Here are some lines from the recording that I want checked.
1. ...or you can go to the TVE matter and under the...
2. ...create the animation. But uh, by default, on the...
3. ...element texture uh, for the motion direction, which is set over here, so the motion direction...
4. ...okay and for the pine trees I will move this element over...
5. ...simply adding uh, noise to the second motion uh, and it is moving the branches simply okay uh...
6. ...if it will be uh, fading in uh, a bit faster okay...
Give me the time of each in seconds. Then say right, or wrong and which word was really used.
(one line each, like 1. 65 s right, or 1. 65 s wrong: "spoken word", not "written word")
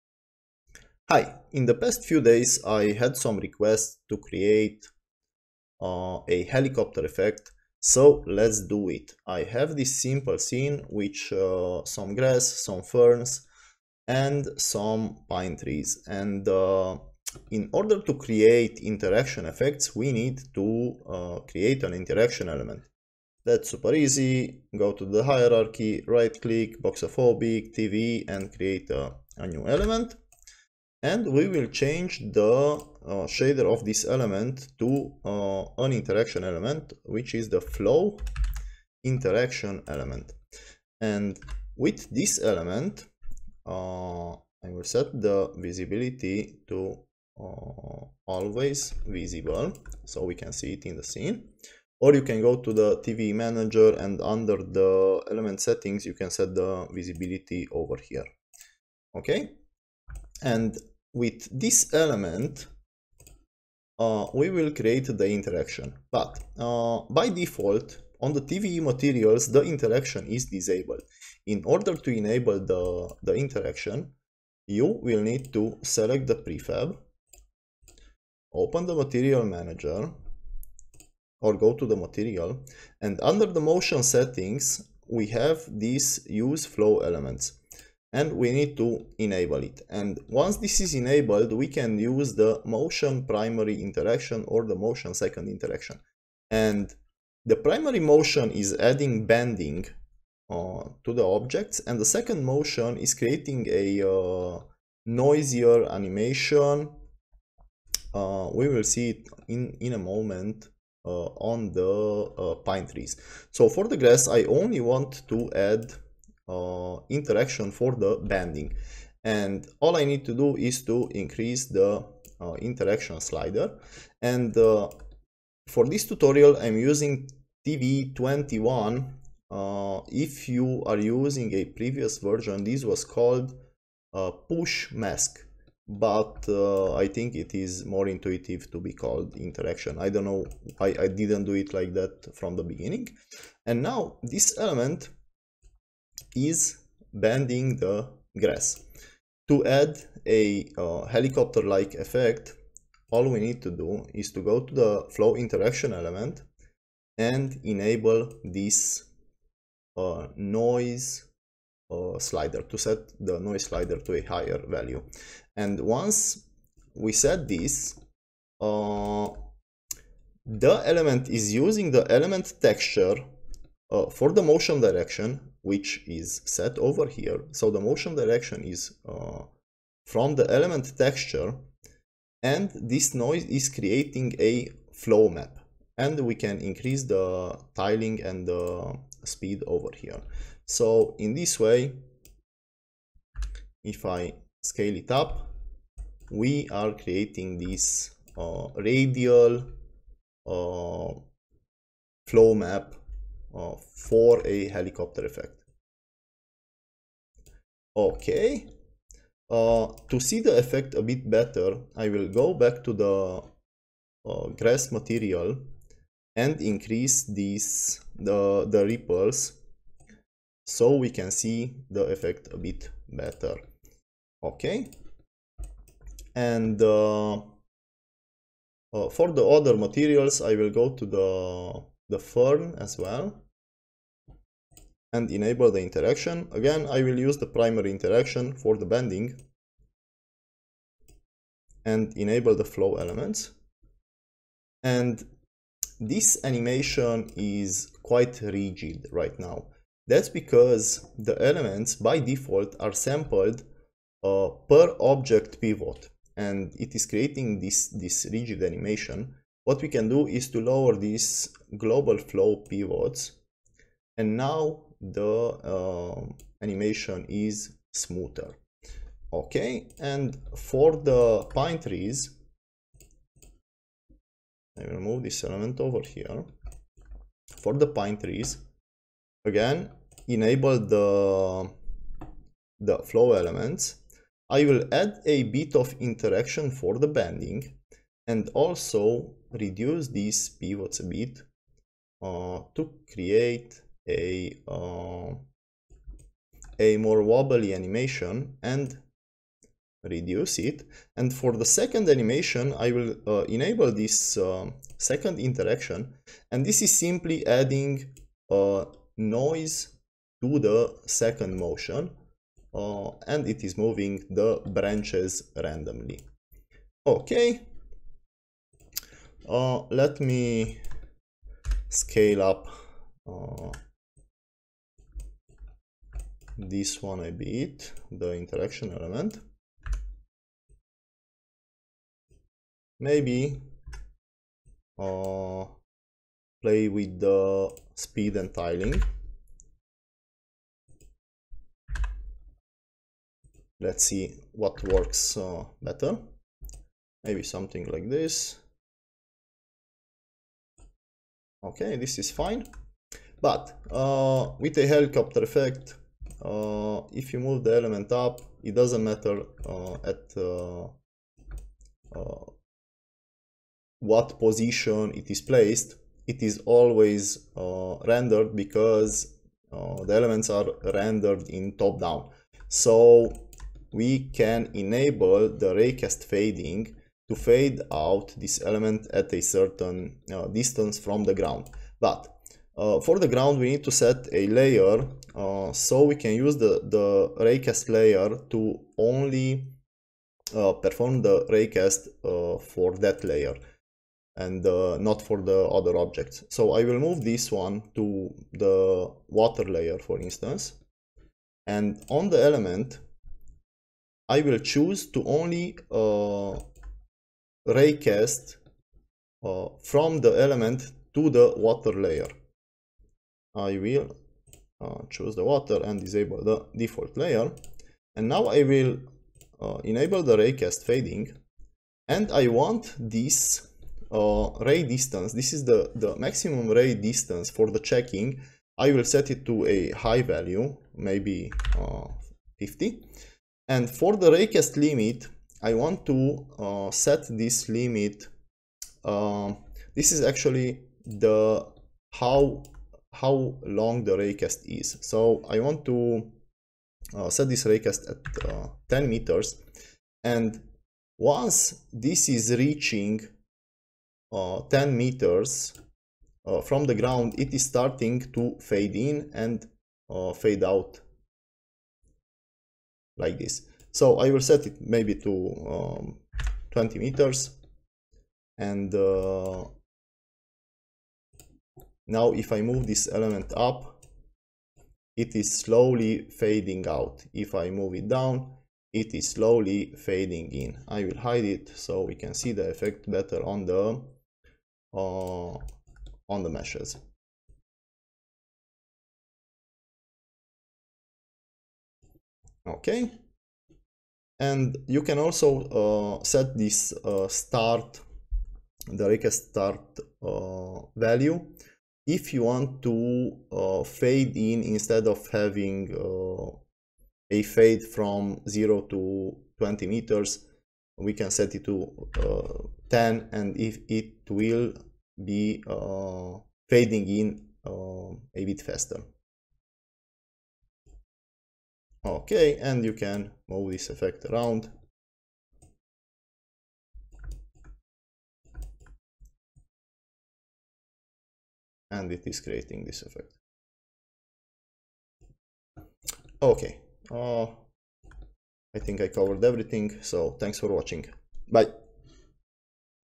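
1. 51 s wrong: "manager", not "matter"
2. 64 s wrong: "interaction", not "animation"
3. 172 s right
4. 269 s right
5. 306 s wrong: "randomly", not "simply"
6. 513 s right.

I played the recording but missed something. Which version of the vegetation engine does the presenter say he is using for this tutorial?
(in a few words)
TVE21.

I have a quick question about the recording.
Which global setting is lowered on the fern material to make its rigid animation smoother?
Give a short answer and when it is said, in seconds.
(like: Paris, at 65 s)
Global flow pivots, at 261 s.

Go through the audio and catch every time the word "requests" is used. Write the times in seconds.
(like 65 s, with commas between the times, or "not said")
3 s.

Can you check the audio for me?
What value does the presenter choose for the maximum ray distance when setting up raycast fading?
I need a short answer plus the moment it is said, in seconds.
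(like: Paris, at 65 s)
50, at 432 s.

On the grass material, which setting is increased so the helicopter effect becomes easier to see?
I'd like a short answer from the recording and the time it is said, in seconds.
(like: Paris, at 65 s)
Ripples, at 218 s.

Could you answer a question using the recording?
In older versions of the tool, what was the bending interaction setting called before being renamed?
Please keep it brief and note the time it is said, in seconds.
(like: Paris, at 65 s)
Push mask, at 134 s.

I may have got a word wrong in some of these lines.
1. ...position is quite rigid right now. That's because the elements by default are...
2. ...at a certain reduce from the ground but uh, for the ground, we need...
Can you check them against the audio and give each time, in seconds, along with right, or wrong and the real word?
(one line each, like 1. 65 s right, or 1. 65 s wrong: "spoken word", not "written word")
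1. 246 s wrong: "animation", not "position"
2. 379 s wrong: "distance", not "reduce".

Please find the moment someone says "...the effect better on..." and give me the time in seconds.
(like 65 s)
482 s.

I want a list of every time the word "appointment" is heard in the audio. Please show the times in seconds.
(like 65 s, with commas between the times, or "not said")
not said.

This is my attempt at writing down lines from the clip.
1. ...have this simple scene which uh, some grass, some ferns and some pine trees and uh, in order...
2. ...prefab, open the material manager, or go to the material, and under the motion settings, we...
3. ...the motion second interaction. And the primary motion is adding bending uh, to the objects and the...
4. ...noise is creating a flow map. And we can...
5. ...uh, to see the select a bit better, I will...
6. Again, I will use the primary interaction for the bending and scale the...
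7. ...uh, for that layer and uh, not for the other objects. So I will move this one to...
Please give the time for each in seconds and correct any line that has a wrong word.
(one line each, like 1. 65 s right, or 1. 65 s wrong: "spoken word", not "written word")
1. 9 s right
2. 76 s right
3. 94 s right
4. 183 s right
5. 209 s wrong: "effect", not "select"
6. 236 s wrong: "enable", not "scale"
7. 392 s right.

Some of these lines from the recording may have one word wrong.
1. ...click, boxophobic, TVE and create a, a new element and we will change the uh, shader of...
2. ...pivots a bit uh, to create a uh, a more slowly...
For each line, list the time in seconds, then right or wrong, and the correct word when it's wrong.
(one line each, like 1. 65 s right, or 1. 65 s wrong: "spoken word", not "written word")
1. 26 s right
2. 290 s wrong: "wobbly", not "slowly".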